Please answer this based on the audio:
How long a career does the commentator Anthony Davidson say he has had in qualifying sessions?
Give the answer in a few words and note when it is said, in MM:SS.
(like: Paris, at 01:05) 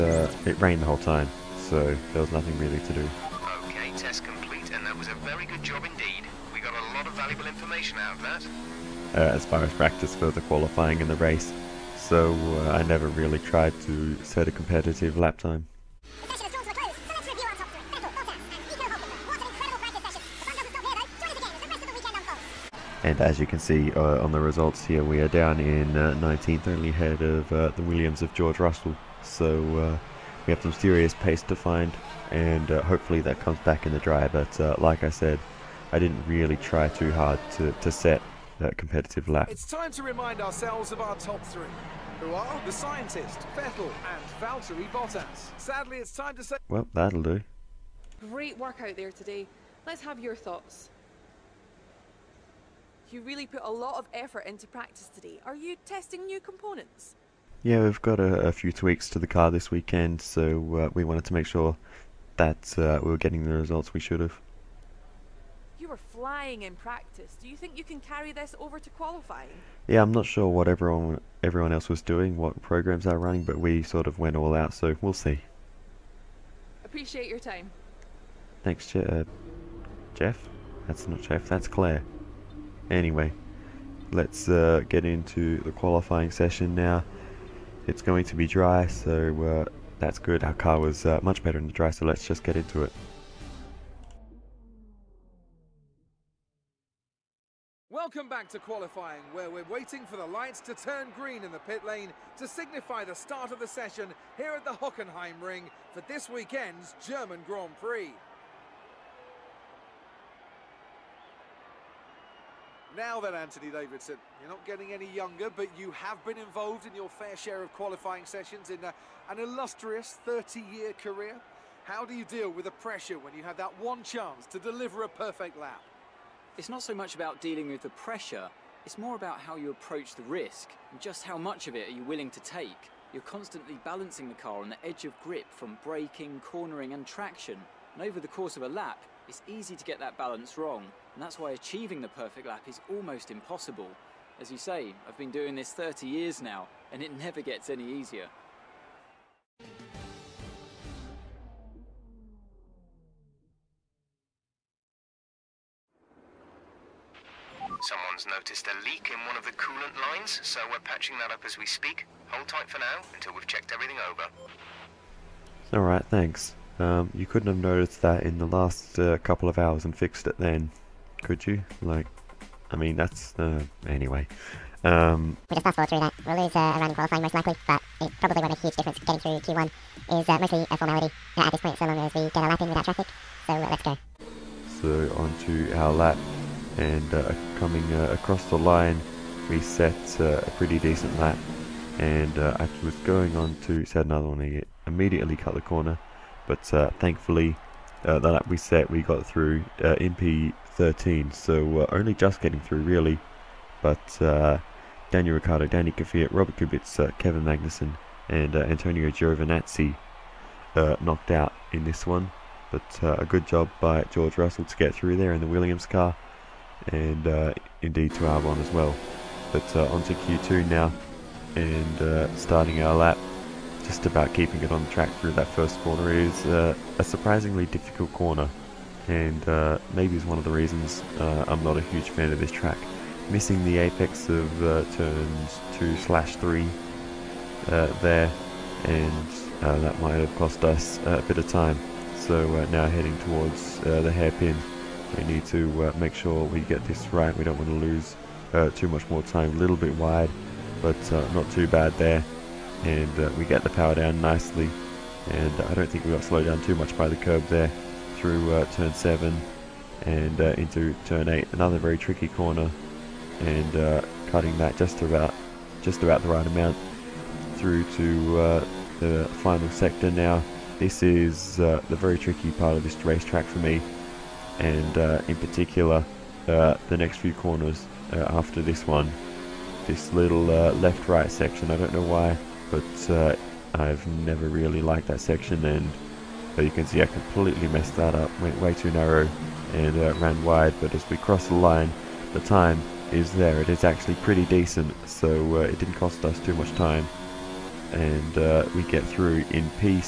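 30 years, at 02:00.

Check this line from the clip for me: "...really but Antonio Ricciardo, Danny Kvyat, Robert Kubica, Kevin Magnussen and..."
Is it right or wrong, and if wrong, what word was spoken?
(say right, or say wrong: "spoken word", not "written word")
wrong: "Daniel", not "Antonio".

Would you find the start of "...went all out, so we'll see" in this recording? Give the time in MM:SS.
01:14.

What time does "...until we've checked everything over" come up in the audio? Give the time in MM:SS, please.
02:43.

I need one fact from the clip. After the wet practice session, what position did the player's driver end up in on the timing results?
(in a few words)
19th.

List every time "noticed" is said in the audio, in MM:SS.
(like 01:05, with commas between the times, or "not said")
02:38, 02:47.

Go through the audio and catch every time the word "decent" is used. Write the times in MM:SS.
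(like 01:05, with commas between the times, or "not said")
03:10, 04:54.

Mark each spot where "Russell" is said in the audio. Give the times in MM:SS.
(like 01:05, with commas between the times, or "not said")
00:28, 03:34.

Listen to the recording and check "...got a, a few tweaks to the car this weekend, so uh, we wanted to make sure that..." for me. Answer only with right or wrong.
right.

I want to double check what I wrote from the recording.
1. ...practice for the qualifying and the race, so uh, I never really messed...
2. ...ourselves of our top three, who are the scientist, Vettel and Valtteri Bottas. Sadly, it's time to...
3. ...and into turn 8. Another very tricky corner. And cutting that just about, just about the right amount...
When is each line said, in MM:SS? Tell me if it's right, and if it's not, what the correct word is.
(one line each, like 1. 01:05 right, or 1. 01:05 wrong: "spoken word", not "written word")
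1. 00:09 wrong: "tried", not "messed"
2. 00:40 right
3. 04:20 right.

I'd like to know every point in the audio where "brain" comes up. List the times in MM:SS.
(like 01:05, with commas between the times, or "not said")
not said.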